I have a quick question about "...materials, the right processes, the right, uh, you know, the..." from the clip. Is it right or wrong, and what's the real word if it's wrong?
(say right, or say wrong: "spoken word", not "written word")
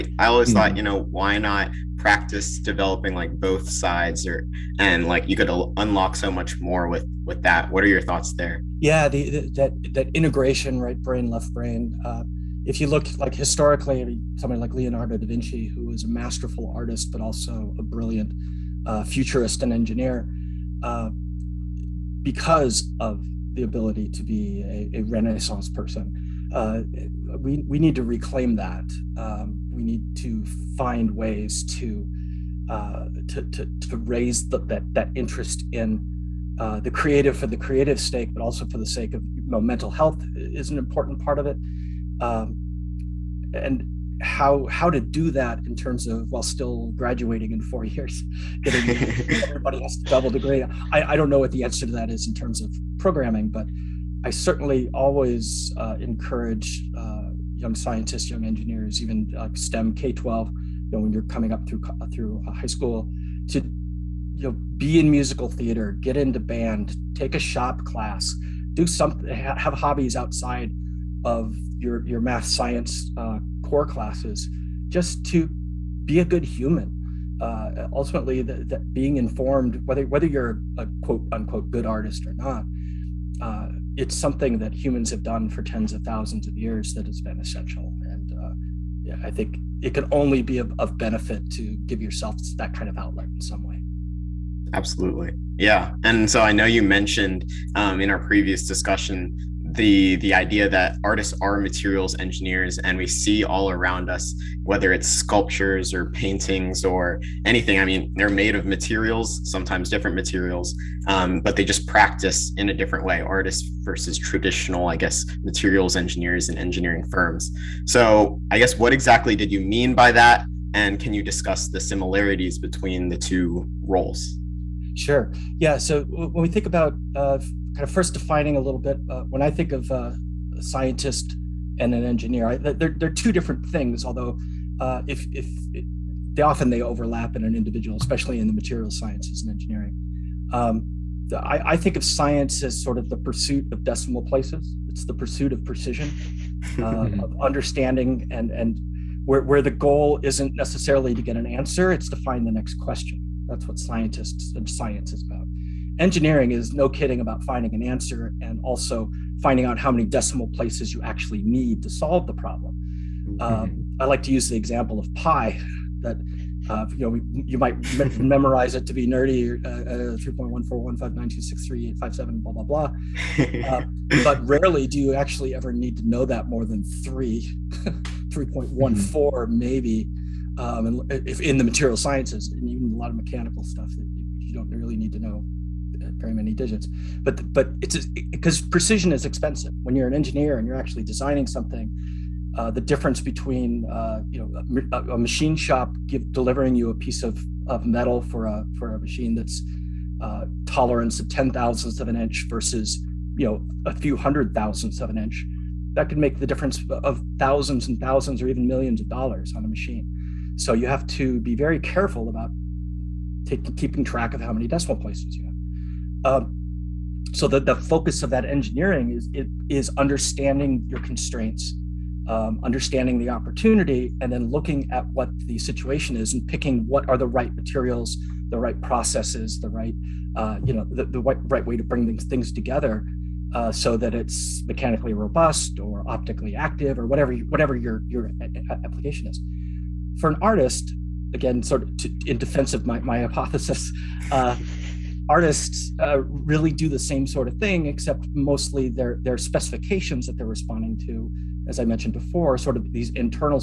right.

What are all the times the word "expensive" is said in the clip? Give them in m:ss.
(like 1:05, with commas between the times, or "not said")
3:09.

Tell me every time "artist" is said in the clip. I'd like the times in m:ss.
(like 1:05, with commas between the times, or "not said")
0:16, 1:21, 1:41, 1:53, 4:00, 4:05.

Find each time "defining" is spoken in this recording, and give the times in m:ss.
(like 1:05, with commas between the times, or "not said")
2:08.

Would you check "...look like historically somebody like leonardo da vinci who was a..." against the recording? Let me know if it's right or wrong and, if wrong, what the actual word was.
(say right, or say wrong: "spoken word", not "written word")
right.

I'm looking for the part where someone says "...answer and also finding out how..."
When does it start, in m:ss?
2:37.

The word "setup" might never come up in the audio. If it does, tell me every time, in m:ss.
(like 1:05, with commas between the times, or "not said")
not said.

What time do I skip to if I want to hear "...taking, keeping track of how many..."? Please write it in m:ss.
3:33.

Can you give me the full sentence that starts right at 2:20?
Um, I, I, think of science as sort of the pursuit of decimal places.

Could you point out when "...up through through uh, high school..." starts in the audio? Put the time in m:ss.
1:01.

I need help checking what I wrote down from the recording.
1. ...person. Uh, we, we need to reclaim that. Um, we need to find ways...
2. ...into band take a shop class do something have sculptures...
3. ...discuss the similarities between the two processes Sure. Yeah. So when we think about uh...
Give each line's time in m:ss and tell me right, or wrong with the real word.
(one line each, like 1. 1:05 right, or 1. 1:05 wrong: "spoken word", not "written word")
1. 0:25 right
2. 1:06 wrong: "hobbies", not "sculptures"
3. 2:01 wrong: "roles", not "processes".